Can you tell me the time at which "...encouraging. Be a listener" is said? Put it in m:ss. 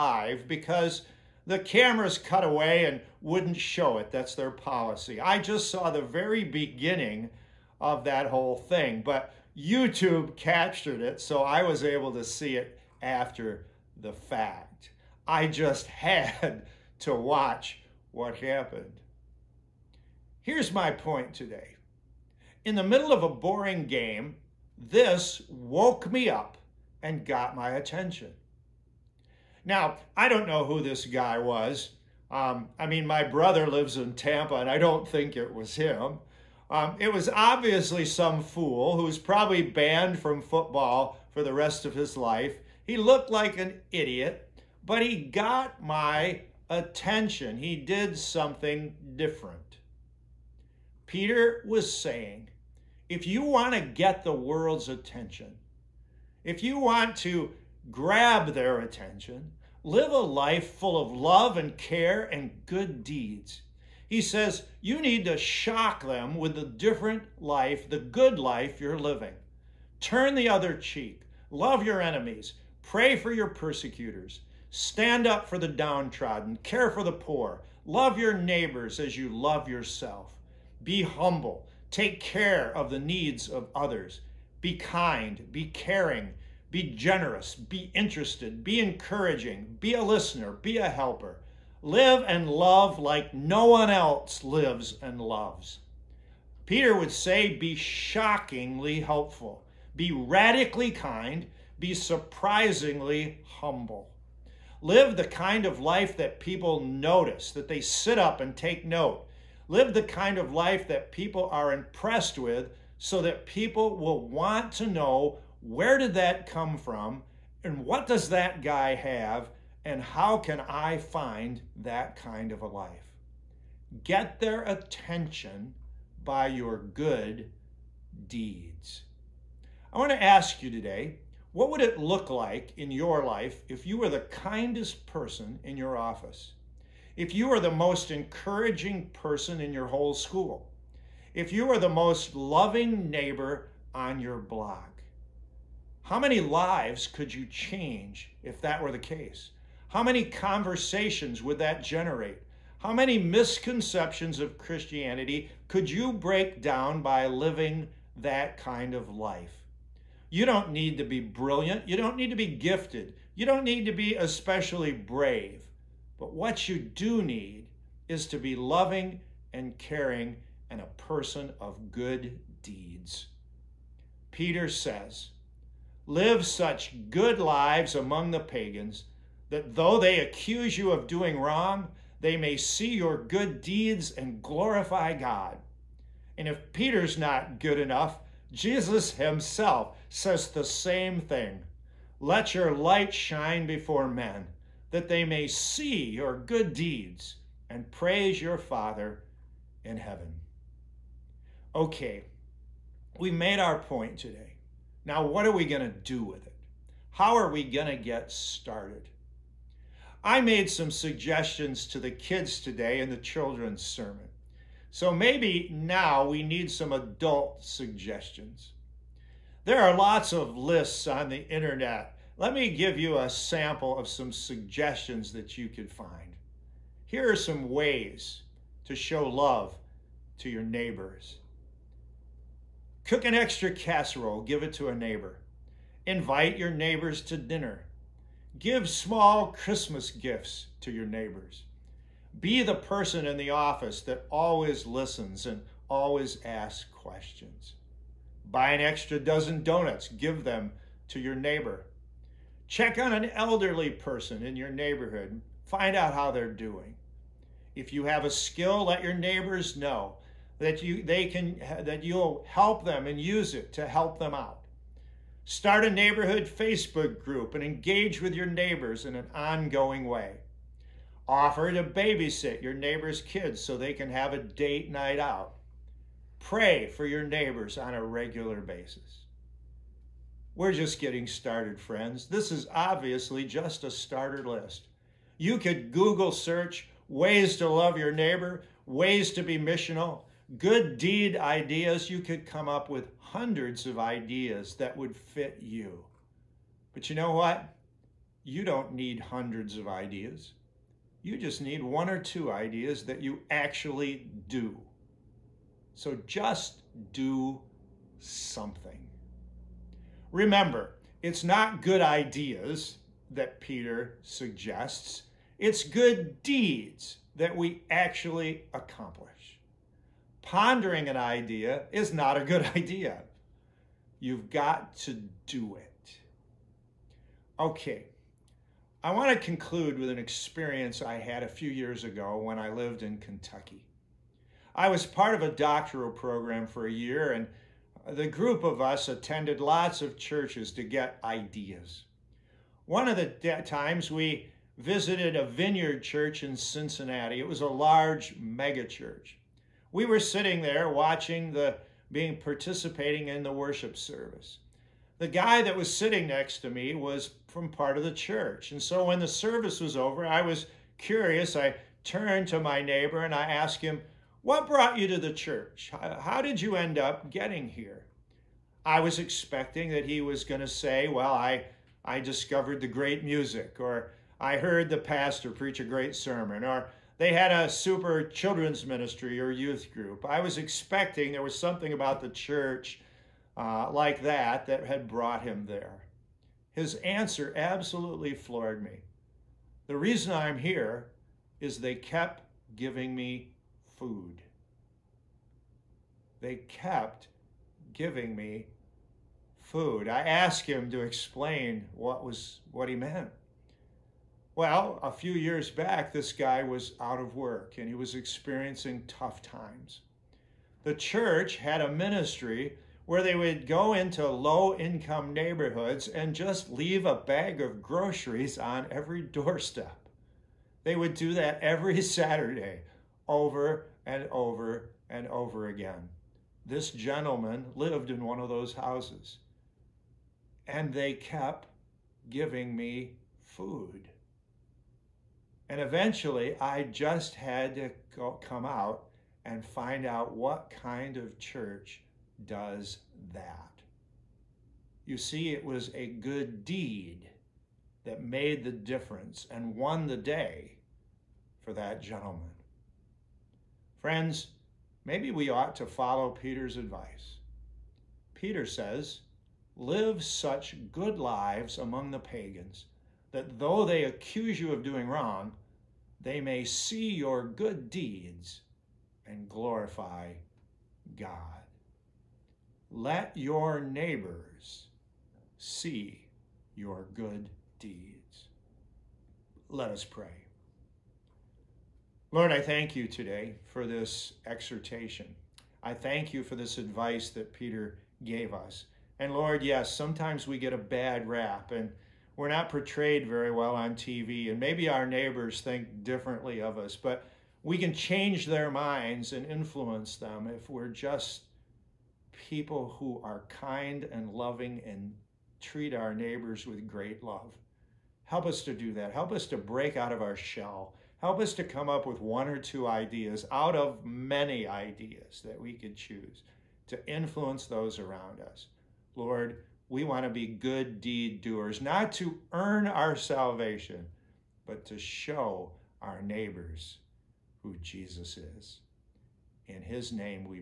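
1:28.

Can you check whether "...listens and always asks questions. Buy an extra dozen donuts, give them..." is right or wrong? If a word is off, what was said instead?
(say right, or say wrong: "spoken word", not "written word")
right.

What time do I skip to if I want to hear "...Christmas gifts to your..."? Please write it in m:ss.
3:59.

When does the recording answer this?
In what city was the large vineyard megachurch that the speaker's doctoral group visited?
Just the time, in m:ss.
5:46.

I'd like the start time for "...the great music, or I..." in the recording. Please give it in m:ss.
6:12.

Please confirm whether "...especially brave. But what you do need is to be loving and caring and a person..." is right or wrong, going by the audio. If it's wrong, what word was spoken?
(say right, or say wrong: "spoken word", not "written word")
right.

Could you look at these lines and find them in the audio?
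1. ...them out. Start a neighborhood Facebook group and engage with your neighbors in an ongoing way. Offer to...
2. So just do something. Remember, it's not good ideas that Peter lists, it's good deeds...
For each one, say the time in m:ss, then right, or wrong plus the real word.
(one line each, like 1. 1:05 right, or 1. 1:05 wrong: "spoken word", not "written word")
1. 4:24 right
2. 5:05 wrong: "suggests", not "lists".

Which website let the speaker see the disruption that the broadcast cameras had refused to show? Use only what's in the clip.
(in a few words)
YouTube.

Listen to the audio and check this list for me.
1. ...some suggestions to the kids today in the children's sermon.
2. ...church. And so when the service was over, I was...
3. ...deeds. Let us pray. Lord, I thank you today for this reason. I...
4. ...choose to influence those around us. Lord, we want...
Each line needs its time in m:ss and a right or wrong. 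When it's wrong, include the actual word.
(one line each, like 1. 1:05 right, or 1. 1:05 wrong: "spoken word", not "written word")
1. 3:30 right
2. 5:58 right
3. 7:57 wrong: "exhortation", not "reason"
4. 8:35 right.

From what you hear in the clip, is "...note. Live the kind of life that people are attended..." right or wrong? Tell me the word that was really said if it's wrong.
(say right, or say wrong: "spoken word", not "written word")
wrong: "impressed", not "attended".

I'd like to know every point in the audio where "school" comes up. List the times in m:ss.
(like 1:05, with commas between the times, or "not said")
2:20.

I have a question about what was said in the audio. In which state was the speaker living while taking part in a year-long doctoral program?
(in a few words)
Kentucky.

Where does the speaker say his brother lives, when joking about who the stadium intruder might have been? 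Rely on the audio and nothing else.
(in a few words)
Tampa.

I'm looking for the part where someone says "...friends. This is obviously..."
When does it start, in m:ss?
4:41.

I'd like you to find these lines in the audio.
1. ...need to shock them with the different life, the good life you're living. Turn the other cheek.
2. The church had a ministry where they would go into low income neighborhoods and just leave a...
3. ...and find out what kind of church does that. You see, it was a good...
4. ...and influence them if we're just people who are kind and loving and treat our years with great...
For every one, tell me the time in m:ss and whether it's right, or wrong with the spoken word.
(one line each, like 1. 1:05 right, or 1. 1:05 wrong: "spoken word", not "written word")
1. 1:05 right
2. 6:50 right
3. 7:19 right
4. 8:19 wrong: "neighbors", not "years".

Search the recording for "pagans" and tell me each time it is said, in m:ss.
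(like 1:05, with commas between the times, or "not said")
2:58, 7:42.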